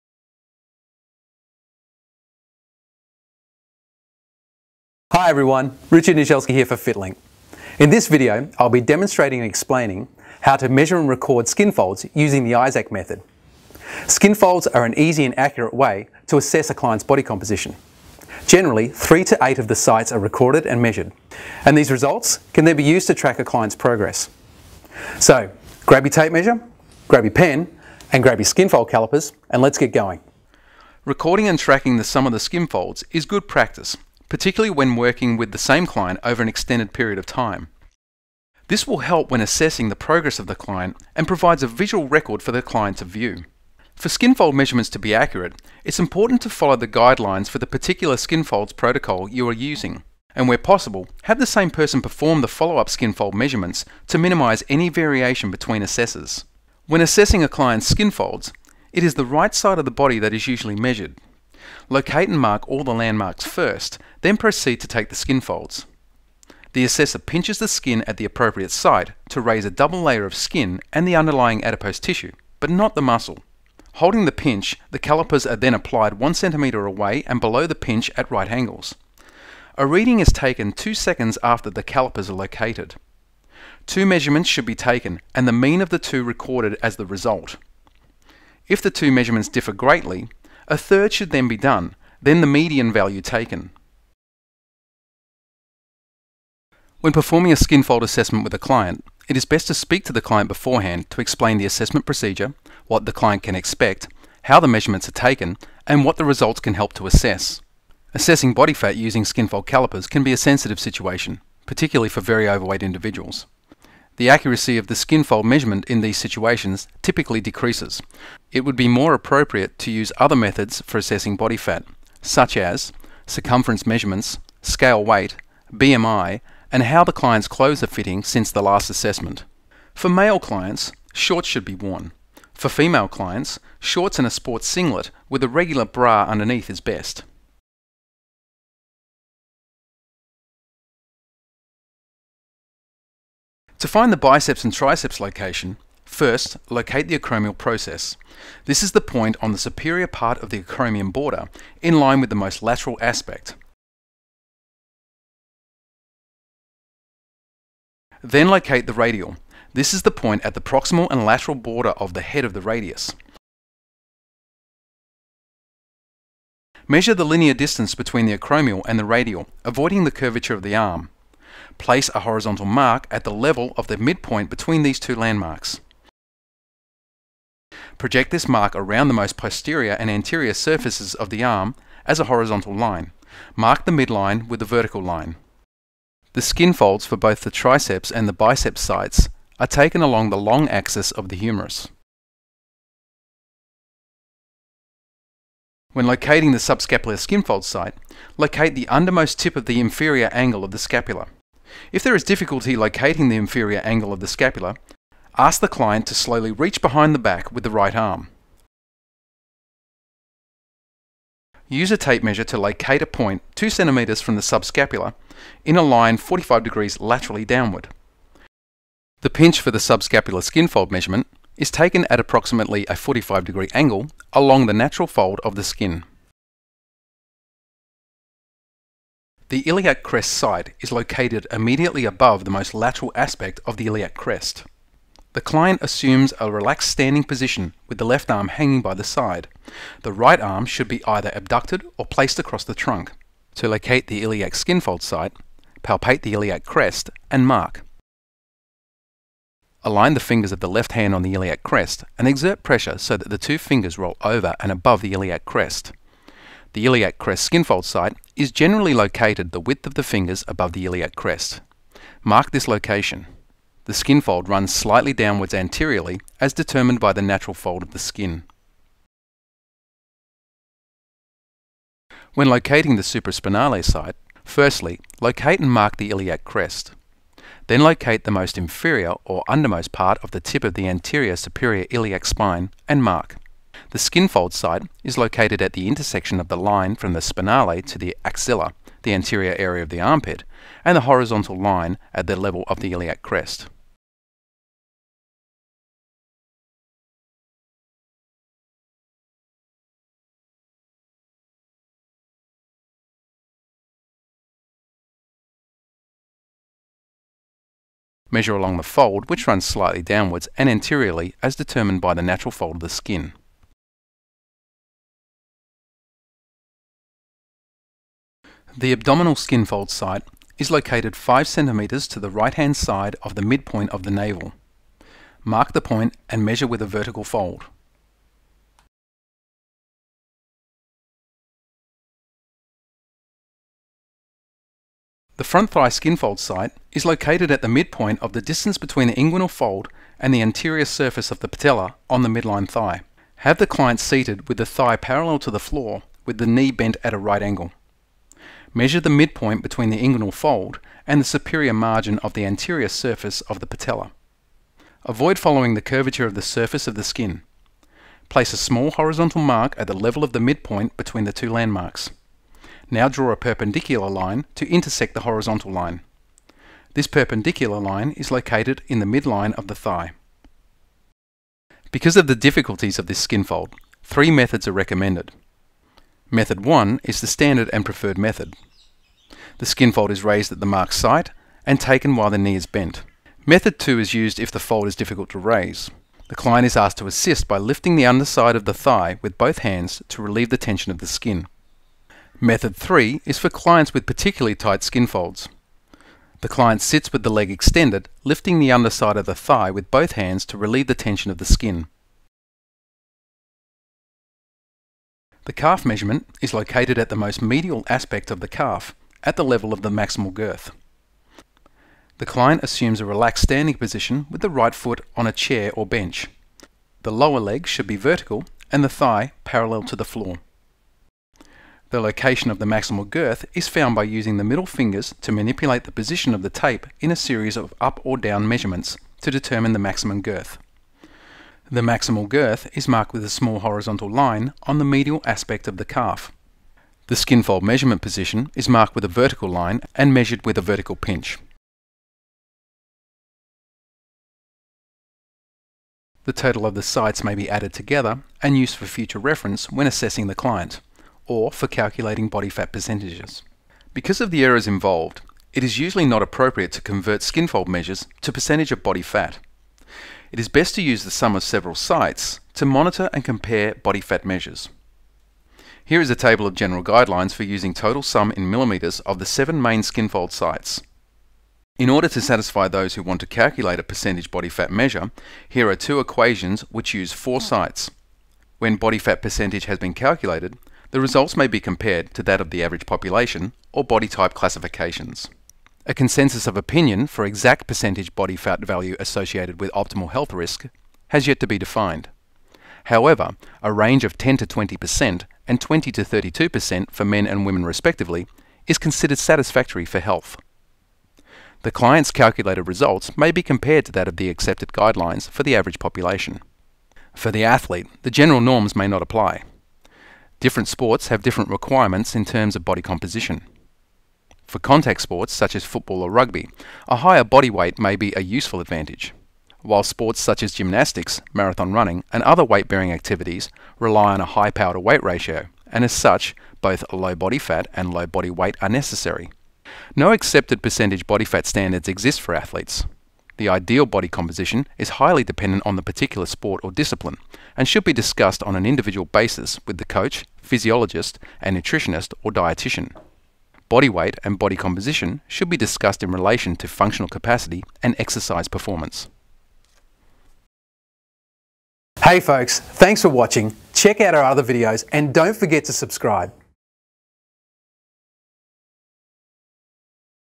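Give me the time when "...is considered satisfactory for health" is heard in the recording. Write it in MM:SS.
08:18.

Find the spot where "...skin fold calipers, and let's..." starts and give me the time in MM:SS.
00:28.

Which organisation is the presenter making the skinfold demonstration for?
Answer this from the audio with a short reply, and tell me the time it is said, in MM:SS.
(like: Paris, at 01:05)
FitLink, at 00:06.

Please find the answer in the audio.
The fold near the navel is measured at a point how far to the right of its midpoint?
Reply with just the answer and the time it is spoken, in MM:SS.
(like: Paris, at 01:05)
5 cm, at 05:21.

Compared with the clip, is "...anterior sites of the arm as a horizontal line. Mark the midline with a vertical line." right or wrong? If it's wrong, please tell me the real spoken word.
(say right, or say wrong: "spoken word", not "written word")
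wrong: "surfaces", not "sites".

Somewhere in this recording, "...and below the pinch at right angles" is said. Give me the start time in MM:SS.
01:17.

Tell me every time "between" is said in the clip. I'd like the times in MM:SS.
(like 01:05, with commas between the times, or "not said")
00:55, 02:47, 02:54, 05:38, 05:49, 06:00.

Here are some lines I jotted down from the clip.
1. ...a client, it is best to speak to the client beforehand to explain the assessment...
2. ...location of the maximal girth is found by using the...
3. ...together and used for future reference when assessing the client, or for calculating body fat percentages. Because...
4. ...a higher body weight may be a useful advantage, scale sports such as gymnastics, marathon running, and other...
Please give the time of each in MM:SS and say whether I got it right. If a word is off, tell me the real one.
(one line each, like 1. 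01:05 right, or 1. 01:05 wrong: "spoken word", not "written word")
1. 01:38 right
2. 07:01 right
3. 07:27 right
4. 08:36 wrong: "while", not "scale".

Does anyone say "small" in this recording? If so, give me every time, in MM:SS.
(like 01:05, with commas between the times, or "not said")
05:58, 07:13.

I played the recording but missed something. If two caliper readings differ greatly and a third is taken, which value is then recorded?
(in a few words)
median.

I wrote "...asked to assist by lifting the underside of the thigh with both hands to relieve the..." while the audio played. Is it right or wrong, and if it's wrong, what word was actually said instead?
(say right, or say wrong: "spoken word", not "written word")
right.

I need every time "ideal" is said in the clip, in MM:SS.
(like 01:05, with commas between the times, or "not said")
08:53.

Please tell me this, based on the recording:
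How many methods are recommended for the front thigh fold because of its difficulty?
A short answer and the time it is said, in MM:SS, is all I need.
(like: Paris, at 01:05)
3, at 06:14.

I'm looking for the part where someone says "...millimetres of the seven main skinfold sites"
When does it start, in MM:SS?
07:48.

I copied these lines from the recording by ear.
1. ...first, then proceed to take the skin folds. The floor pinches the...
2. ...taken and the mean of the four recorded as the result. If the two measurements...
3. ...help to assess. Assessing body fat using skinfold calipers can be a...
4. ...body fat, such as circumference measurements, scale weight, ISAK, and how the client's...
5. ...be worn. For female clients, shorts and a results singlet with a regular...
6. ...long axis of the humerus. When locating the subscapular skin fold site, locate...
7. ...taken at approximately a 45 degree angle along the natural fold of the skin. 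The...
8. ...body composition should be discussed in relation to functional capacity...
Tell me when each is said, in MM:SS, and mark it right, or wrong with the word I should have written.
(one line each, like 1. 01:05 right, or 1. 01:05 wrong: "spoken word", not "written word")
1. 01:03 wrong: "assessor", not "floor"
2. 01:24 wrong: "two", not "four"
3. 01:46 right
4. 02:01 wrong: "BMI", not "ISAK"
5. 02:11 wrong: "sports", not "results"
6. 03:10 right
7. 03:41 right
8. 09:04 right.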